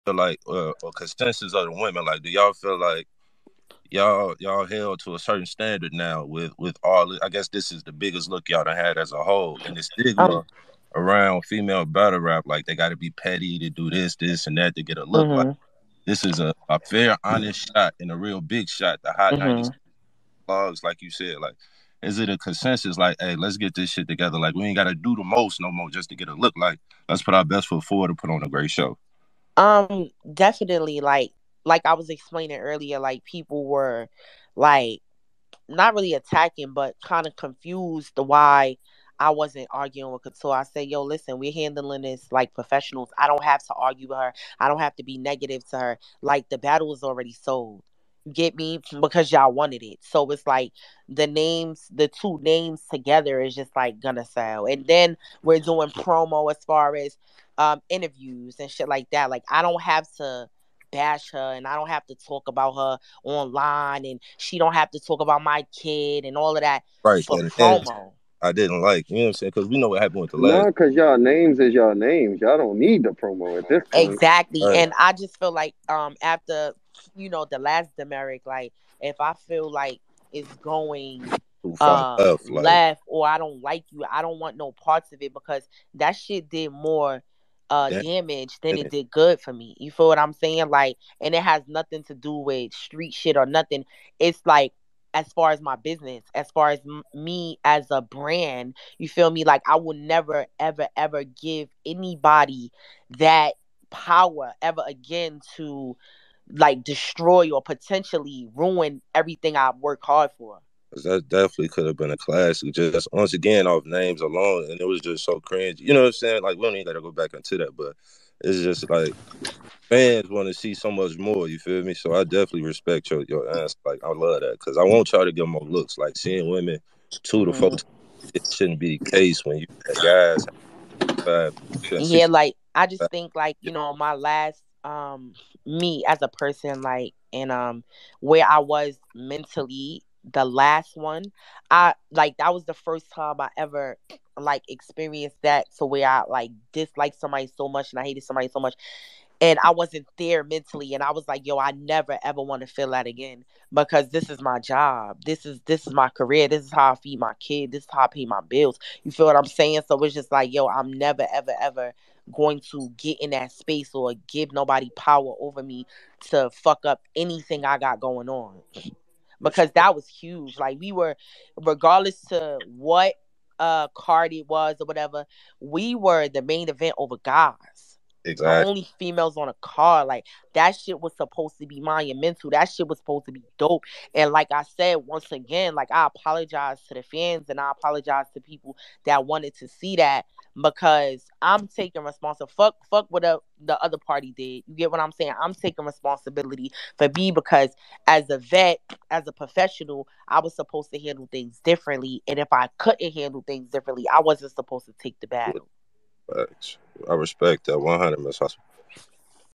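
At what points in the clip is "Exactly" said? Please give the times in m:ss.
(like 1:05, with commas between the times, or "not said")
1:14, 2:58.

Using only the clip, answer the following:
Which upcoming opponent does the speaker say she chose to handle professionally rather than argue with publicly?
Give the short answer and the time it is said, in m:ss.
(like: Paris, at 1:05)
Couture, at 0:40.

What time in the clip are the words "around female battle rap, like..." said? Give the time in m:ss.
0:10.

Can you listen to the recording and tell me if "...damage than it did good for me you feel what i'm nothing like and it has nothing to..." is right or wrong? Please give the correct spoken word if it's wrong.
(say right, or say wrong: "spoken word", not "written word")
wrong: "saying", not "nothing".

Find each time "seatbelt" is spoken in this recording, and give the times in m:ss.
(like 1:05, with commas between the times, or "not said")
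not said.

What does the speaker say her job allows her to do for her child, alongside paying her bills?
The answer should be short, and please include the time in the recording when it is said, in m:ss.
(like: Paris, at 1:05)
feed my kid, at 2:36.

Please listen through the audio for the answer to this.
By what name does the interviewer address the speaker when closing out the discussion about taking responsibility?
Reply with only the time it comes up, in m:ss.
3:28.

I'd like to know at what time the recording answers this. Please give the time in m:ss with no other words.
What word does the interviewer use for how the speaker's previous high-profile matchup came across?
1:55.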